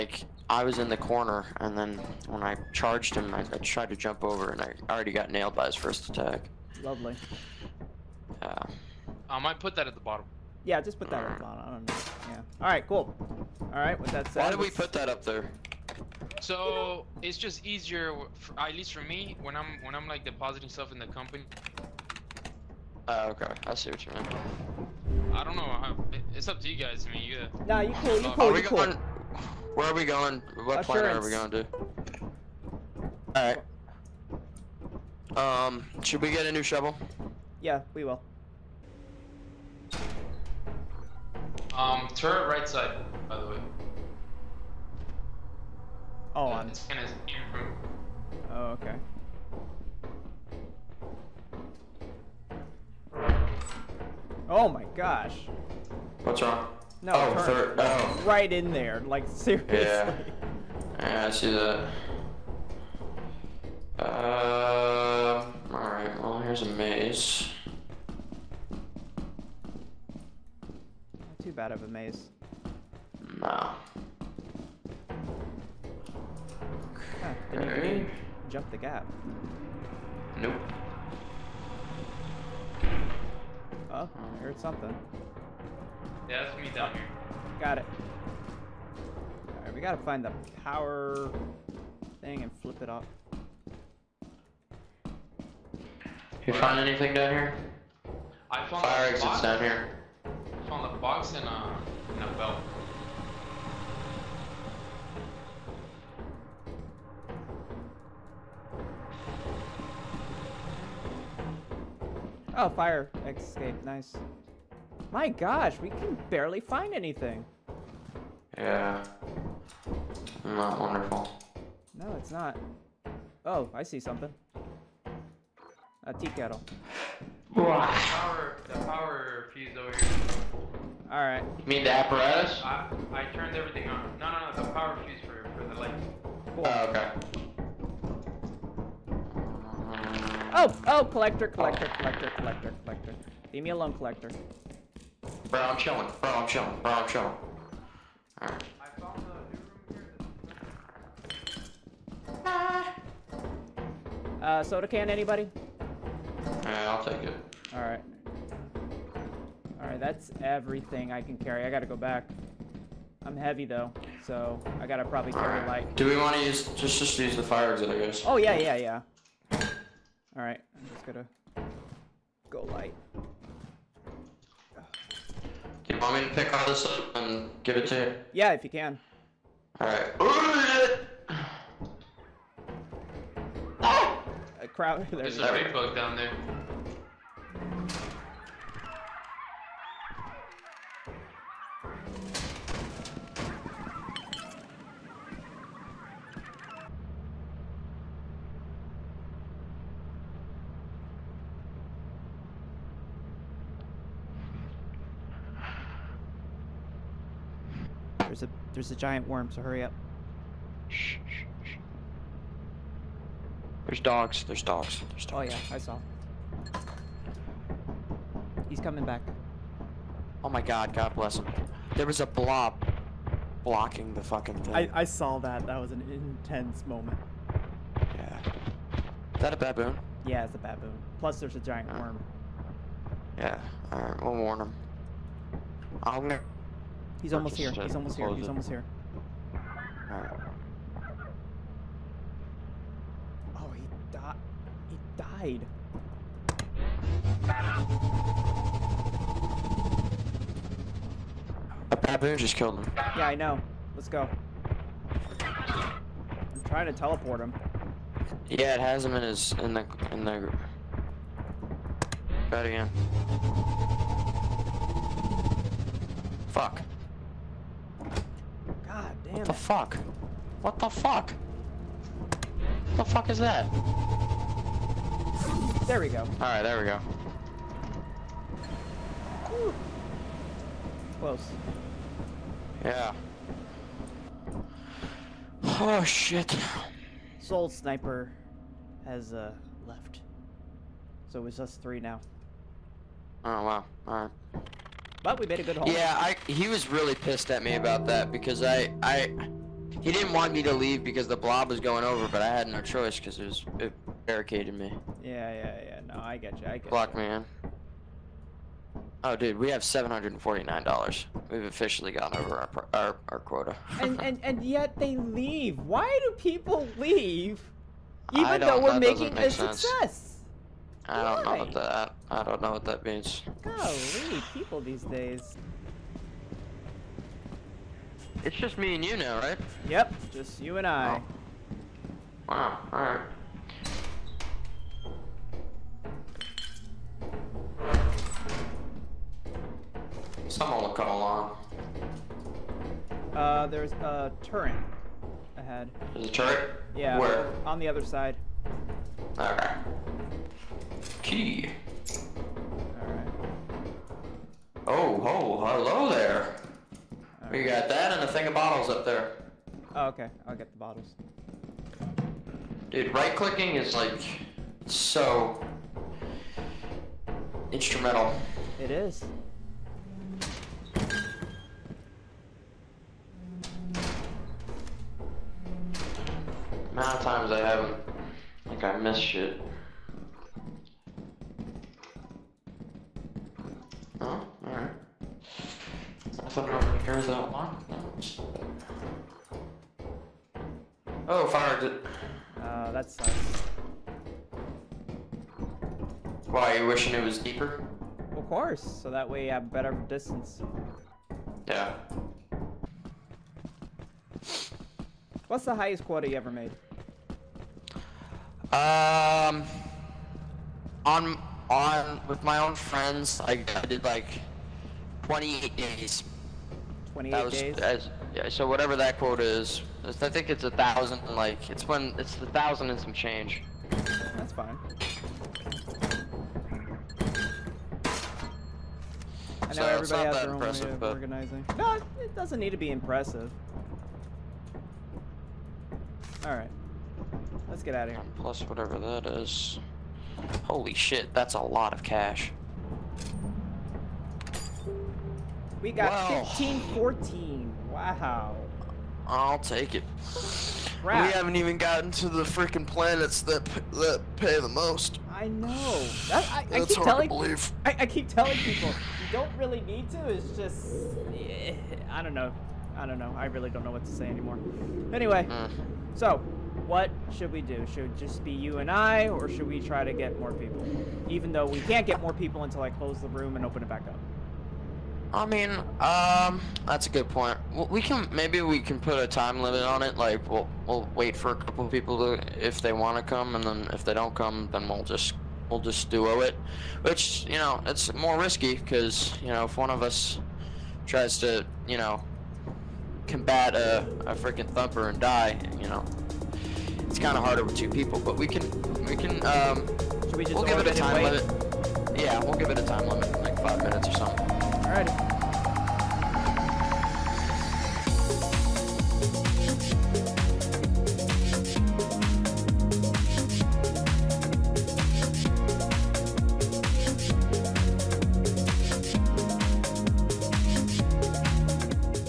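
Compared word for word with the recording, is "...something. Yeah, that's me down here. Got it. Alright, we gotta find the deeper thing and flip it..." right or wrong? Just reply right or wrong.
wrong.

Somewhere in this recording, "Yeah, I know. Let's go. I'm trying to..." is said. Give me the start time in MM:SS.
04:13.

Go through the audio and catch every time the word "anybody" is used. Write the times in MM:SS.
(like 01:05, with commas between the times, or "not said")
02:35.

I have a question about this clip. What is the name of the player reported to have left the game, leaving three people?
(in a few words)
Soul Sniper.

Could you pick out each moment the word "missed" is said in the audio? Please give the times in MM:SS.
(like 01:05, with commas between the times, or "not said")
06:18.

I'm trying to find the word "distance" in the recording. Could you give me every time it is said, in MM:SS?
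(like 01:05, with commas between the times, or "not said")
06:40.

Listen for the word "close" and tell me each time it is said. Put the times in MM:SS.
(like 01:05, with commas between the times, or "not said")
04:41, 07:52.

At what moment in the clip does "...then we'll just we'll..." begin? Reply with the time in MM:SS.
08:04.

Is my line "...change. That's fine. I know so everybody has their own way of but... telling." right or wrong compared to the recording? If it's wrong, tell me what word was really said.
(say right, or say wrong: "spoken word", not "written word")
wrong: "organizing", not "telling".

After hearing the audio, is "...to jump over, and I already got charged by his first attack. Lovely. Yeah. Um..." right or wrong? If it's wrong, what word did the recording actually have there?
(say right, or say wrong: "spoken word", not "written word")
wrong: "nailed", not "charged".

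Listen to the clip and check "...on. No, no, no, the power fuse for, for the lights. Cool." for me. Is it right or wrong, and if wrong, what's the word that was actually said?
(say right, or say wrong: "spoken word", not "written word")
right.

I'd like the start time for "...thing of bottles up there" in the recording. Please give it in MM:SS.
05:58.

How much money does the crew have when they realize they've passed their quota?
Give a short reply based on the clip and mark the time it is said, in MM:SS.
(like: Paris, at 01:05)
$749, at 05:09.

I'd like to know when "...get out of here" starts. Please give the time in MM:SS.
07:17.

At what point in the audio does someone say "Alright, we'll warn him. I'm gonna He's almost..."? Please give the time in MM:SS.
03:53.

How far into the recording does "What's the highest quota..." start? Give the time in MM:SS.
06:45.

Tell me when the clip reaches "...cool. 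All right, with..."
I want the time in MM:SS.
00:12.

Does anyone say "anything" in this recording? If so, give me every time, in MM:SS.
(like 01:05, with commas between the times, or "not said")
01:36, 01:56.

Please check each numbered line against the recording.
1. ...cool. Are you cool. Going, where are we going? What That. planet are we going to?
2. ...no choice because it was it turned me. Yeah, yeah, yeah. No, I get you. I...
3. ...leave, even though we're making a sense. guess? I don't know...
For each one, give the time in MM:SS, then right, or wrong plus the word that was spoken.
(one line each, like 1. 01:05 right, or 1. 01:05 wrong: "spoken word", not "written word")
1. 00:28 wrong: "Assurance", not "That"
2. 05:02 wrong: "barricaded", not "turned"
3. 05:16 wrong: "success", not "guess".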